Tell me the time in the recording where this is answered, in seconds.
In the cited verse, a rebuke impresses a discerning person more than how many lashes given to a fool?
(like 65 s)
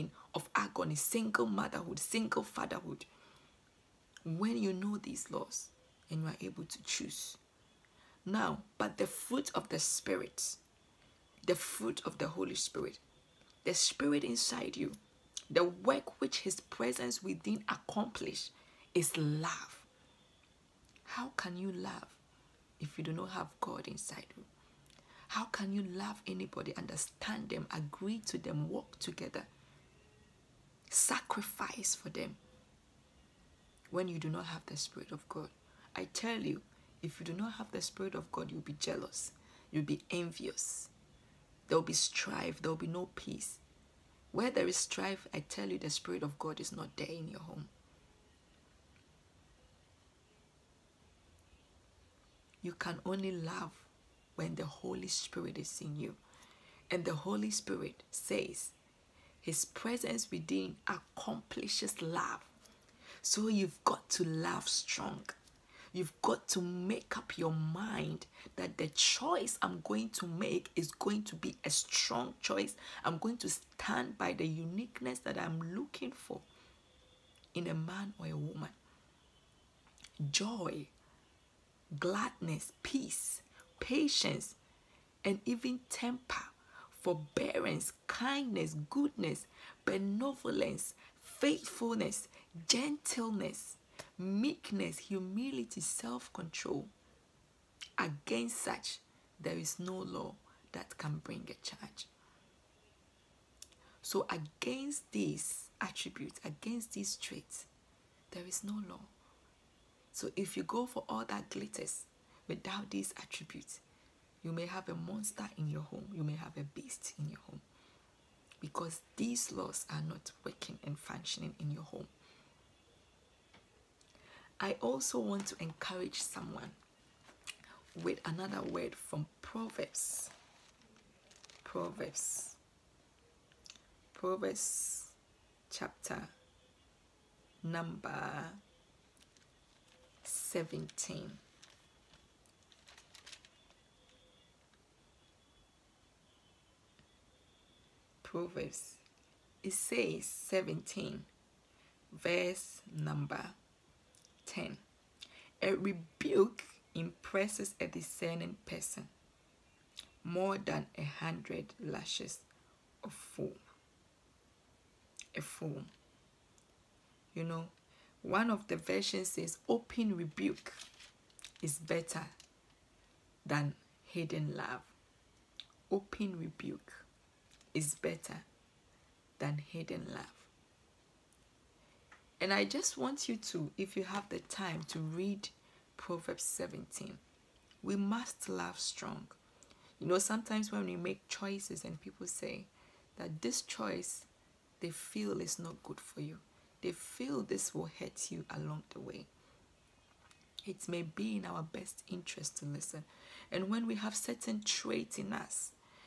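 160 s.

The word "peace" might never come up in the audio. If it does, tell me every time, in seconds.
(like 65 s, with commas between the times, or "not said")
43 s, 82 s.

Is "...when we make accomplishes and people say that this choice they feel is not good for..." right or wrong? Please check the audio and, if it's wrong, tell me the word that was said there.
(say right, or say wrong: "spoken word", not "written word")
wrong: "choices", not "accomplishes".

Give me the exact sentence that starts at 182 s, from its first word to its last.
And I just want you to, if you have the time, to read Proverbs 17.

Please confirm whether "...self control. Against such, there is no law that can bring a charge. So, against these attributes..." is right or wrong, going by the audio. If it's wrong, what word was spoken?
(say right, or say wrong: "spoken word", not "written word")
right.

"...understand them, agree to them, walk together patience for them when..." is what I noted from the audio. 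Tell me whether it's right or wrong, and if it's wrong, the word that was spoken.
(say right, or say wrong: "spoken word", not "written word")
wrong: "sacrifice", not "patience".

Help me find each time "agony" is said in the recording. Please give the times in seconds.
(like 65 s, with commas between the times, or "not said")
0 s.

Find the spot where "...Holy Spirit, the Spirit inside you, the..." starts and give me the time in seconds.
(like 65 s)
12 s.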